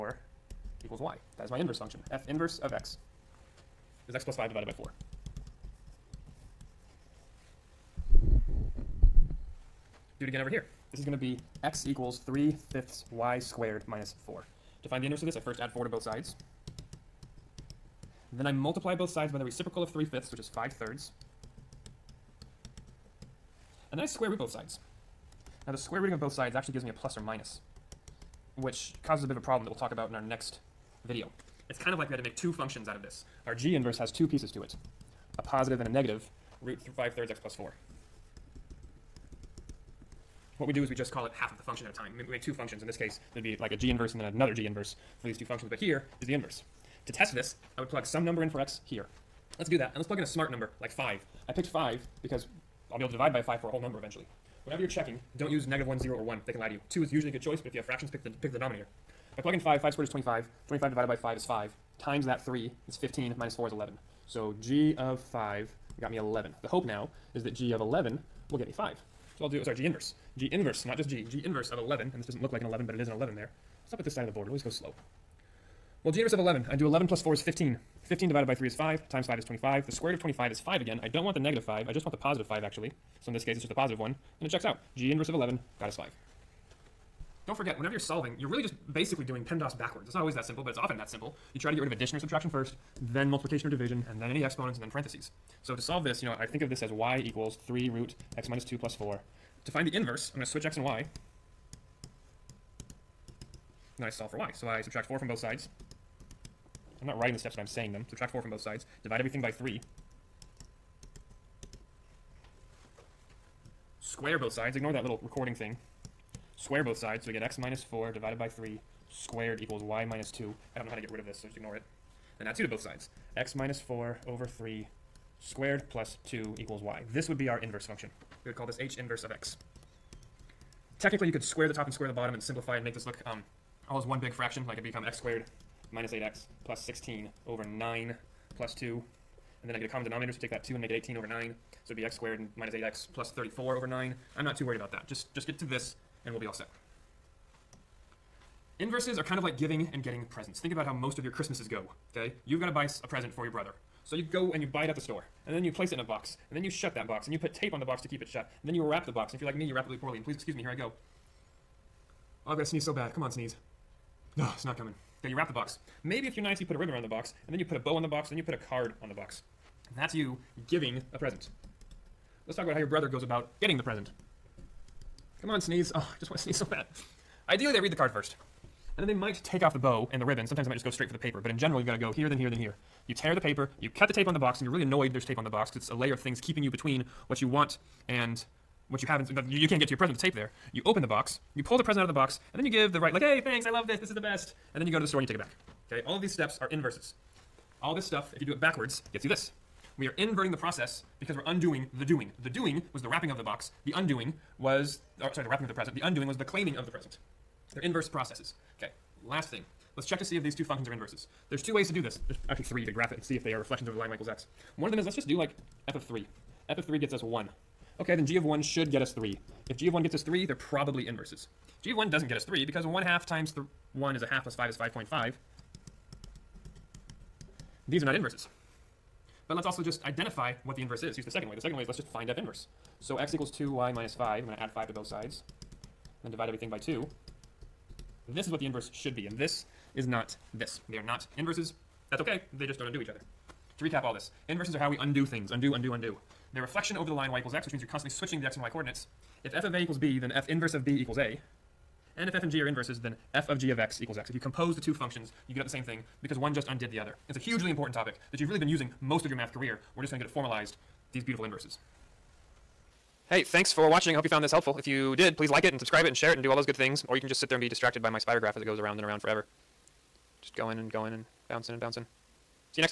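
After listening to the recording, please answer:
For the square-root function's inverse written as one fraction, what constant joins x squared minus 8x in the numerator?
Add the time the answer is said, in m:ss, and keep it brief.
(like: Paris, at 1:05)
34, at 2:22.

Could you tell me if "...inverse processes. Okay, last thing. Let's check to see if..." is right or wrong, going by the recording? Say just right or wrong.
right.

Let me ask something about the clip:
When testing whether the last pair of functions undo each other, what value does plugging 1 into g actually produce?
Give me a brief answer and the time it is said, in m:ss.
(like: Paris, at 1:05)
5.5, at 3:44.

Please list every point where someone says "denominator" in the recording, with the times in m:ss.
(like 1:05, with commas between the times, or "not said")
0:58, 2:20.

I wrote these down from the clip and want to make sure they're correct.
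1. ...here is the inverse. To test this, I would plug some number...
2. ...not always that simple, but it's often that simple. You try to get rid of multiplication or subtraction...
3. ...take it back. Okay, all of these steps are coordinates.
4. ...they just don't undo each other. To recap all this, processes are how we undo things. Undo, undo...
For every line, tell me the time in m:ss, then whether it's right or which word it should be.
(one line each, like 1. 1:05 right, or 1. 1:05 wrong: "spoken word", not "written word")
1. 0:45 right
2. 1:30 wrong: "addition", not "multiplication"
3. 3:15 wrong: "inverses", not "coordinates"
4. 4:02 wrong: "inverses", not "processes".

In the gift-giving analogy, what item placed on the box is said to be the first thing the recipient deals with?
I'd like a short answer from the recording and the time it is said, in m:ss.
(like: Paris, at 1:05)
the card, at 2:57.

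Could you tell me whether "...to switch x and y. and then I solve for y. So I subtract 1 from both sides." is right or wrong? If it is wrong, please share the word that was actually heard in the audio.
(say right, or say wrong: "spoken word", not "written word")
wrong: "4", not "1".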